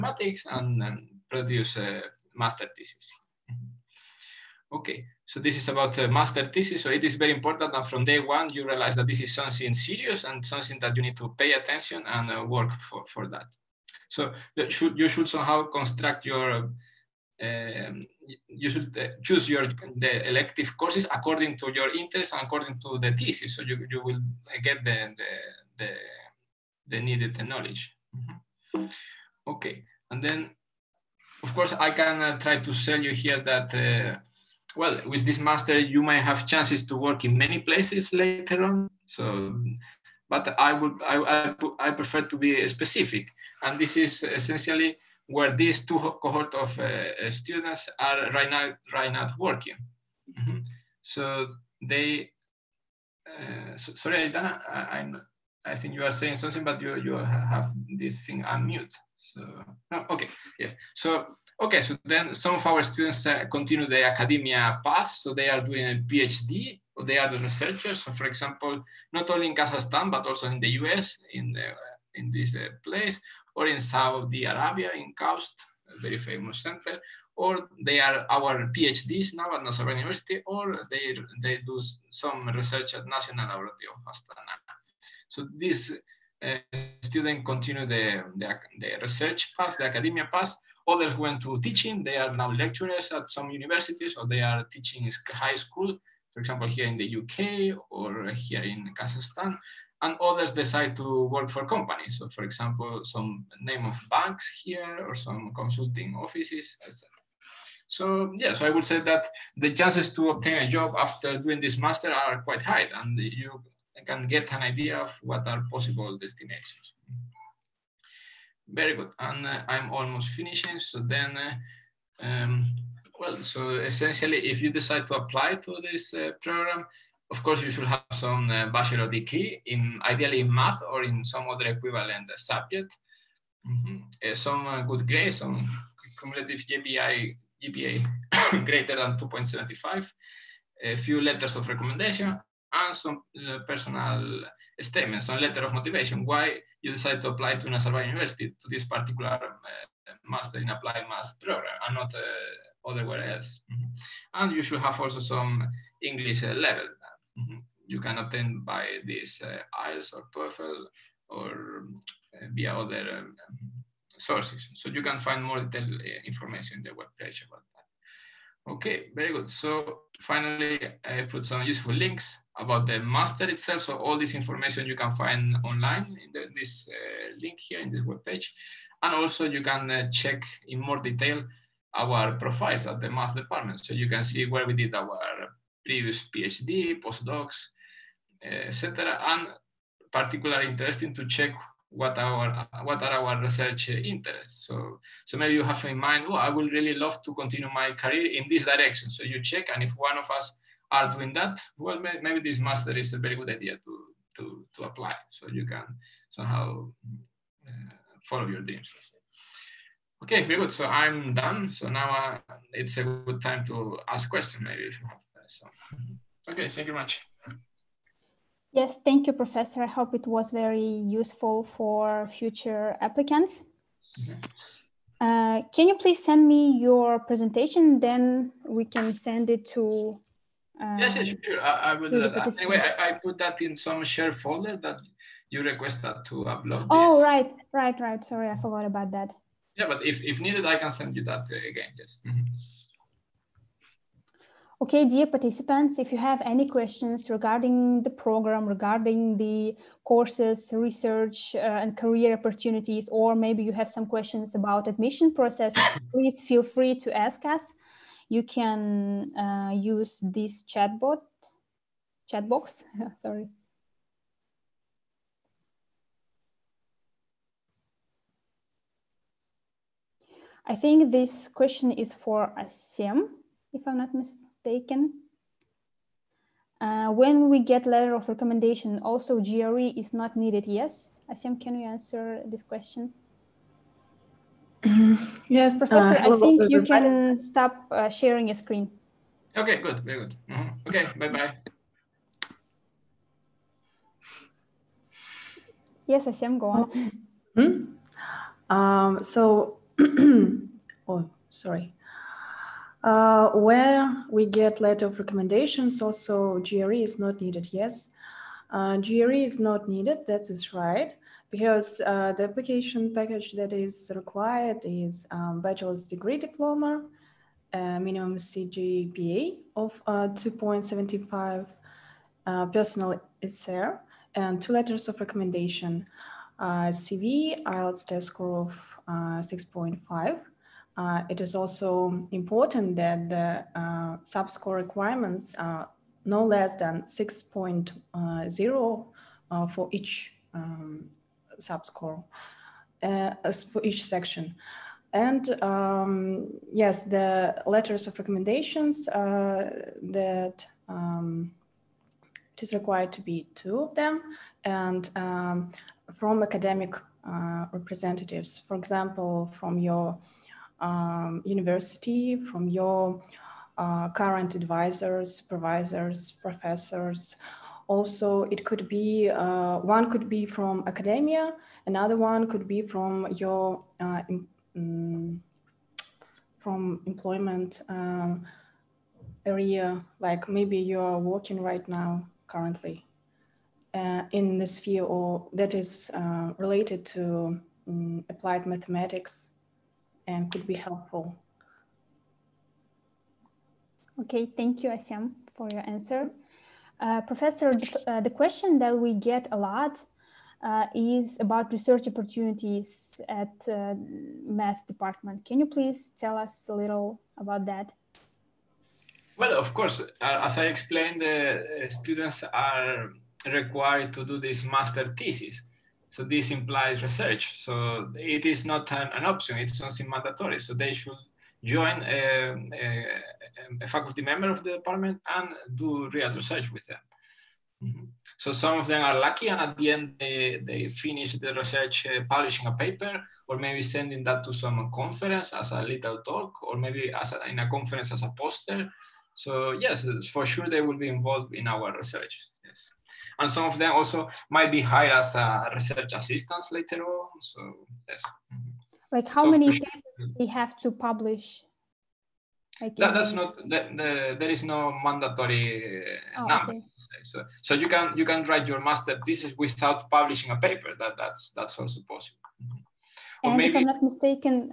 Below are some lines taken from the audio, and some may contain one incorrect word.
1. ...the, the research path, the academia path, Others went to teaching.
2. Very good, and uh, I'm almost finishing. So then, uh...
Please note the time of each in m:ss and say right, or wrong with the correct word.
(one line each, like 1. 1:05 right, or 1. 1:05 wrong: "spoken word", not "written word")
1. 1:28 right
2. 1:58 right.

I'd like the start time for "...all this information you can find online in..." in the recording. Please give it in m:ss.
2:53.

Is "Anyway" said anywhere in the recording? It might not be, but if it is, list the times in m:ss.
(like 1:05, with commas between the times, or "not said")
3:52.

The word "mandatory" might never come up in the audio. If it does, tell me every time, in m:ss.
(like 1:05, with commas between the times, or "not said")
7:00, 7:35.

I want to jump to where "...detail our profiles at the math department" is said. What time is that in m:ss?
3:01.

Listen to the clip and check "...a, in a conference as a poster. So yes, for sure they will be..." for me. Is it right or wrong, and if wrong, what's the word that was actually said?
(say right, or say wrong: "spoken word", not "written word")
right.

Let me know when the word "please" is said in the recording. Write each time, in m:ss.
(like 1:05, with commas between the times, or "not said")
3:45, 4:16, 6:45.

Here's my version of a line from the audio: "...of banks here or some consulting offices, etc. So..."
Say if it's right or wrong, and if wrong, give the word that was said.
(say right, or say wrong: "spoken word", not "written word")
right.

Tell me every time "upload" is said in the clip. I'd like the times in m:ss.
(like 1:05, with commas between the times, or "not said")
3:56.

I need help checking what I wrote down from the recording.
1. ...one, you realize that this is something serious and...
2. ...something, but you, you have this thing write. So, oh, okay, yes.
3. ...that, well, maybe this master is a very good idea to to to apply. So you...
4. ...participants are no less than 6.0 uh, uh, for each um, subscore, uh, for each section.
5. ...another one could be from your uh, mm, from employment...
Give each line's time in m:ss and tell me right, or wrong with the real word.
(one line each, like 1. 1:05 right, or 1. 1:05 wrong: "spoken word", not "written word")
1. 0:08 right
2. 0:56 wrong: "unmute", not "write"
3. 3:21 right
4. 5:34 wrong: "requirements", not "participants"
5. 6:11 right.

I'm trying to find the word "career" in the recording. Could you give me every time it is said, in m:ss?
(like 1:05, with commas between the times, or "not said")
3:17, 4:11.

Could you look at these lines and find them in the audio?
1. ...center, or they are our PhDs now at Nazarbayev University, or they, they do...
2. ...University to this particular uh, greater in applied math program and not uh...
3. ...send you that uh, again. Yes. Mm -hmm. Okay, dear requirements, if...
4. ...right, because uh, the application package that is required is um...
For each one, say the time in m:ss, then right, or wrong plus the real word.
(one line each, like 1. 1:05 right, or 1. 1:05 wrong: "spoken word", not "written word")
1. 1:16 right
2. 2:28 wrong: "master", not "greater"
3. 4:00 wrong: "participants", not "requirements"
4. 5:10 right.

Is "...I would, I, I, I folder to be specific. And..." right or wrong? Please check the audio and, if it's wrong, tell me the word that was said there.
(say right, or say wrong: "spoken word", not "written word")
wrong: "prefer", not "folder".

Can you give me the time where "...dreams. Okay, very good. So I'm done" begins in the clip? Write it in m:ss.
3:28.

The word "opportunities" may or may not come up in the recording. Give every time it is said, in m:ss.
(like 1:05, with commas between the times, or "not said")
4:12, 6:42.